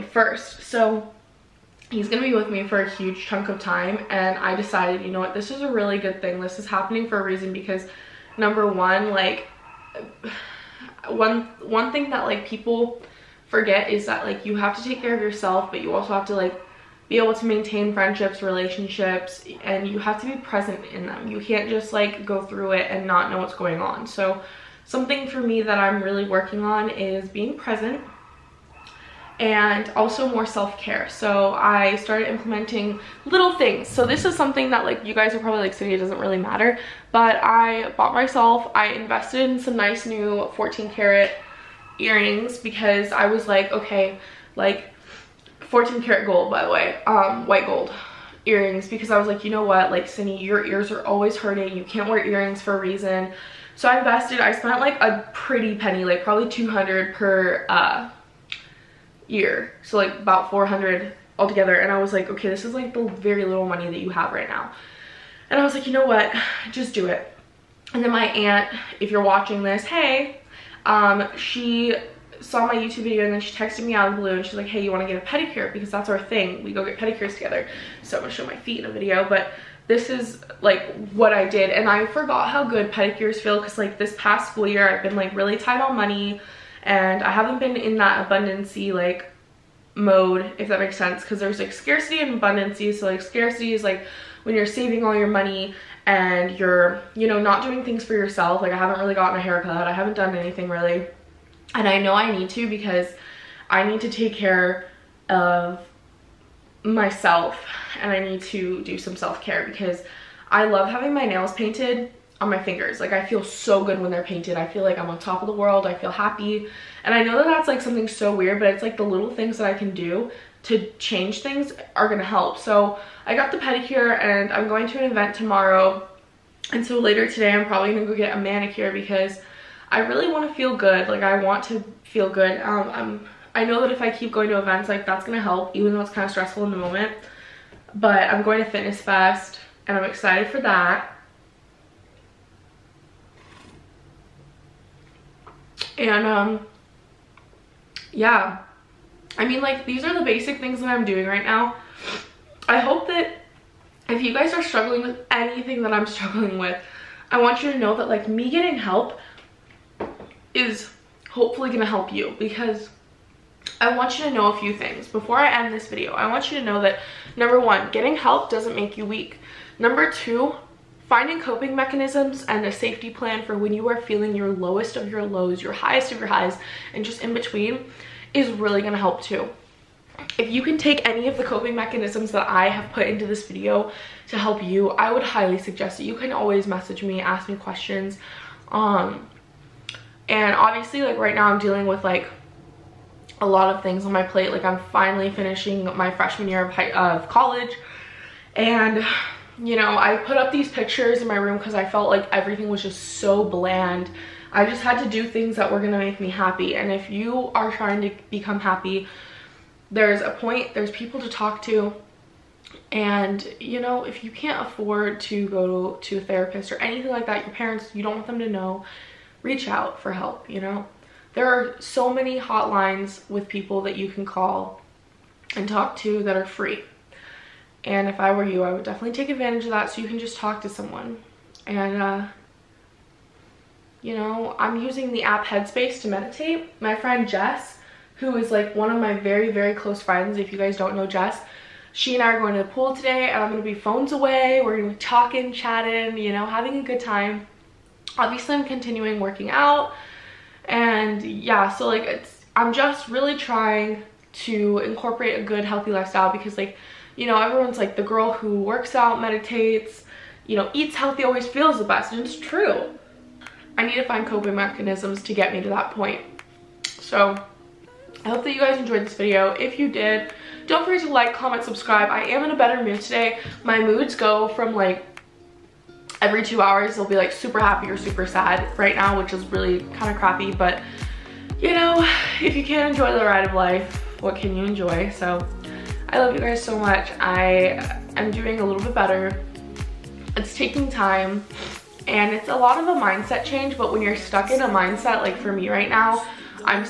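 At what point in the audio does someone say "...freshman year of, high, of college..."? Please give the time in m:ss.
3:16.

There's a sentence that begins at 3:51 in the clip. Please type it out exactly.
And, uh, you know, I'm using the app Headspace to meditate.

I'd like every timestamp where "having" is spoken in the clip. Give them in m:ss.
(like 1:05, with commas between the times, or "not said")
1:50, 4:06.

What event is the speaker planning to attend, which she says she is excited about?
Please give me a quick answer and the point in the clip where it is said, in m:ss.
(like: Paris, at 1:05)
Fitness Fest, at 2:18.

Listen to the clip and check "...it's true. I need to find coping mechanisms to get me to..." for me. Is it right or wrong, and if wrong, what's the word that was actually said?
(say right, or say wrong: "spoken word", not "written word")
right.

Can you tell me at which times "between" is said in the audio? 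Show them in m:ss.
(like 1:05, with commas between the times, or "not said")
2:57.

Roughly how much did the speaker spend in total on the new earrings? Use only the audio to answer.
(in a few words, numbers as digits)
400.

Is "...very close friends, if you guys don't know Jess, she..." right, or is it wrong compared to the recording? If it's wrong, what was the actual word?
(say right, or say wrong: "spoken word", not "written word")
right.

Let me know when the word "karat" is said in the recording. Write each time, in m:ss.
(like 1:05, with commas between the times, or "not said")
0:40, 0:46.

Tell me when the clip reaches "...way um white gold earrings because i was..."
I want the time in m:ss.
0:46.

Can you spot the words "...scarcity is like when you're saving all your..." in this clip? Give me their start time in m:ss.
1:33.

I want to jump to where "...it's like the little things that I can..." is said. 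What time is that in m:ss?
1:58.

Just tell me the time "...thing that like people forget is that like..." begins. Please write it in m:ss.
0:11.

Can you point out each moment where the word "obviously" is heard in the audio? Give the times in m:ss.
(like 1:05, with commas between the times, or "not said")
3:10, 4:08.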